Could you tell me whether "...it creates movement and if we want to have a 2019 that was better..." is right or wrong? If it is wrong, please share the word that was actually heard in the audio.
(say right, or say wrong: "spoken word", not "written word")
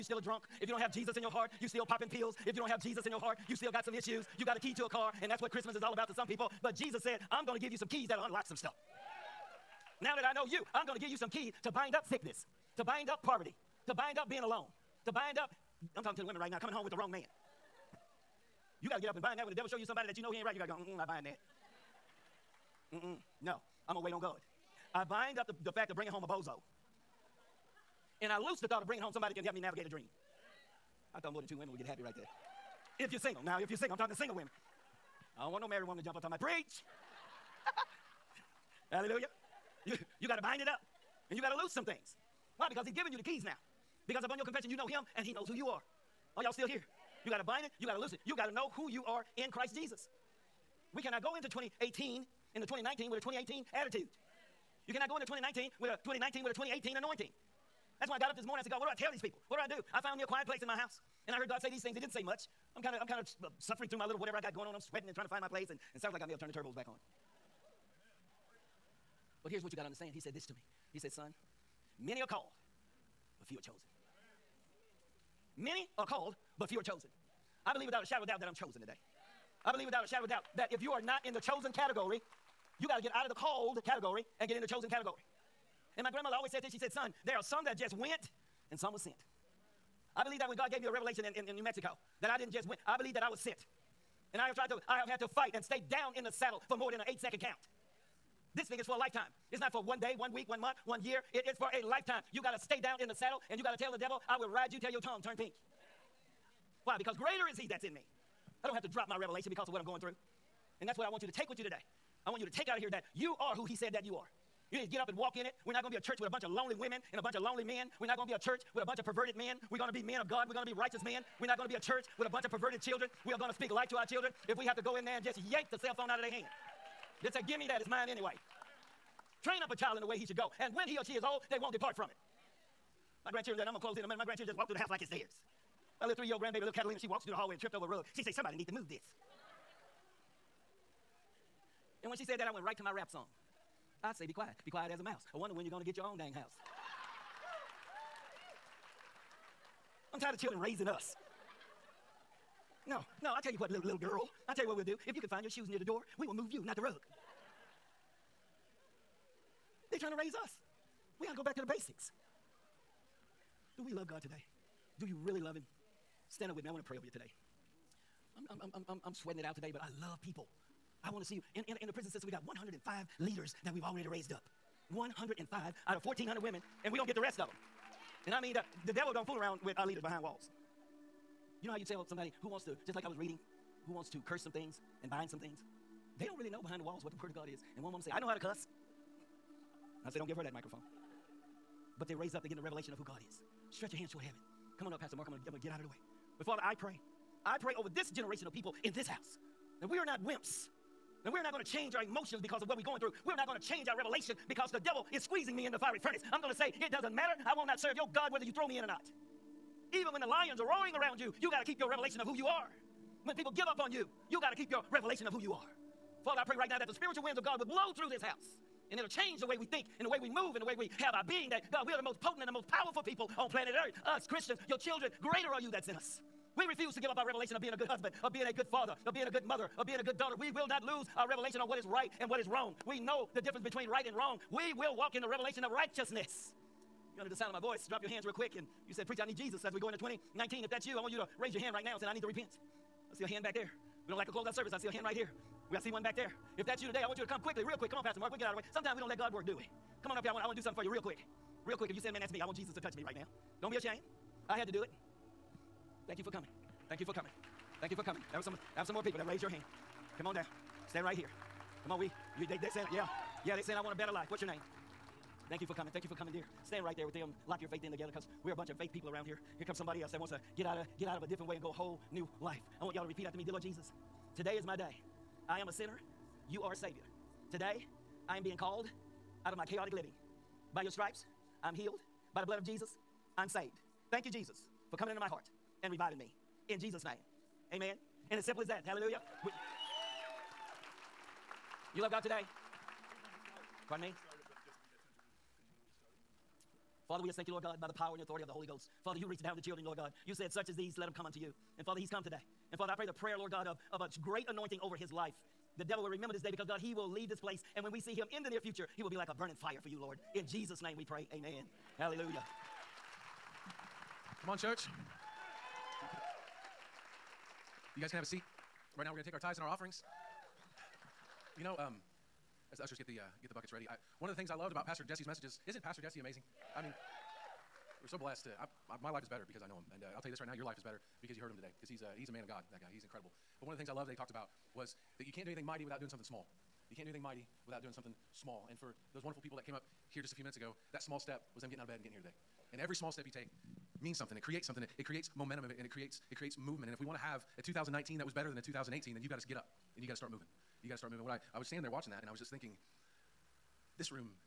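right.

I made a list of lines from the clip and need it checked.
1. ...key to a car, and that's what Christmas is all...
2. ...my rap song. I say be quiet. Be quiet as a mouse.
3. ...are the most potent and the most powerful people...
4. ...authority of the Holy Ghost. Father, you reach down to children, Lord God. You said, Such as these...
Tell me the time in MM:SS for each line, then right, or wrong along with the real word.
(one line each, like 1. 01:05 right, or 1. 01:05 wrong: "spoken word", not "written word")
1. 00:04 right
2. 02:22 right
3. 03:41 right
4. 04:58 right.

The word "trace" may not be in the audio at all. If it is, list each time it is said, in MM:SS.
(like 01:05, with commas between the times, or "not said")
not said.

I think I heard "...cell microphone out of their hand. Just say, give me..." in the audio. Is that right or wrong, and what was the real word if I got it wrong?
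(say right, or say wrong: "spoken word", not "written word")
wrong: "phone", not "microphone".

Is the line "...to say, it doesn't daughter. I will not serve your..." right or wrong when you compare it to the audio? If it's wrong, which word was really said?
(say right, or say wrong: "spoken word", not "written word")
wrong: "matter", not "daughter".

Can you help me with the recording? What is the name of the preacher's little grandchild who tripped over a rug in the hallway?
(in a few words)
Catalina.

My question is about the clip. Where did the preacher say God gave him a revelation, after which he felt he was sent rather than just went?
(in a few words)
New Mexico.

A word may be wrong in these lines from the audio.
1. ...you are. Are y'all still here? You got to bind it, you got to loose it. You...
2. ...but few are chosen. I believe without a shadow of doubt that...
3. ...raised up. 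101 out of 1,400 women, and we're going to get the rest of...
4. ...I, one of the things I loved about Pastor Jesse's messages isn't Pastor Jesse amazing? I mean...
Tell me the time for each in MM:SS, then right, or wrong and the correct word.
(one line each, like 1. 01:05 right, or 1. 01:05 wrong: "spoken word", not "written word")
1. 00:45 right
2. 01:16 right
3. 02:54 wrong: "105", not "101"
4. 05:23 right.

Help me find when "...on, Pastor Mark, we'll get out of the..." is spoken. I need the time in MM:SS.
04:07.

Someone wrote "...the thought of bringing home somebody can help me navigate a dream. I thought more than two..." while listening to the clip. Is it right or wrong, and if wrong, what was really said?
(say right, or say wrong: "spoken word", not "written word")
right.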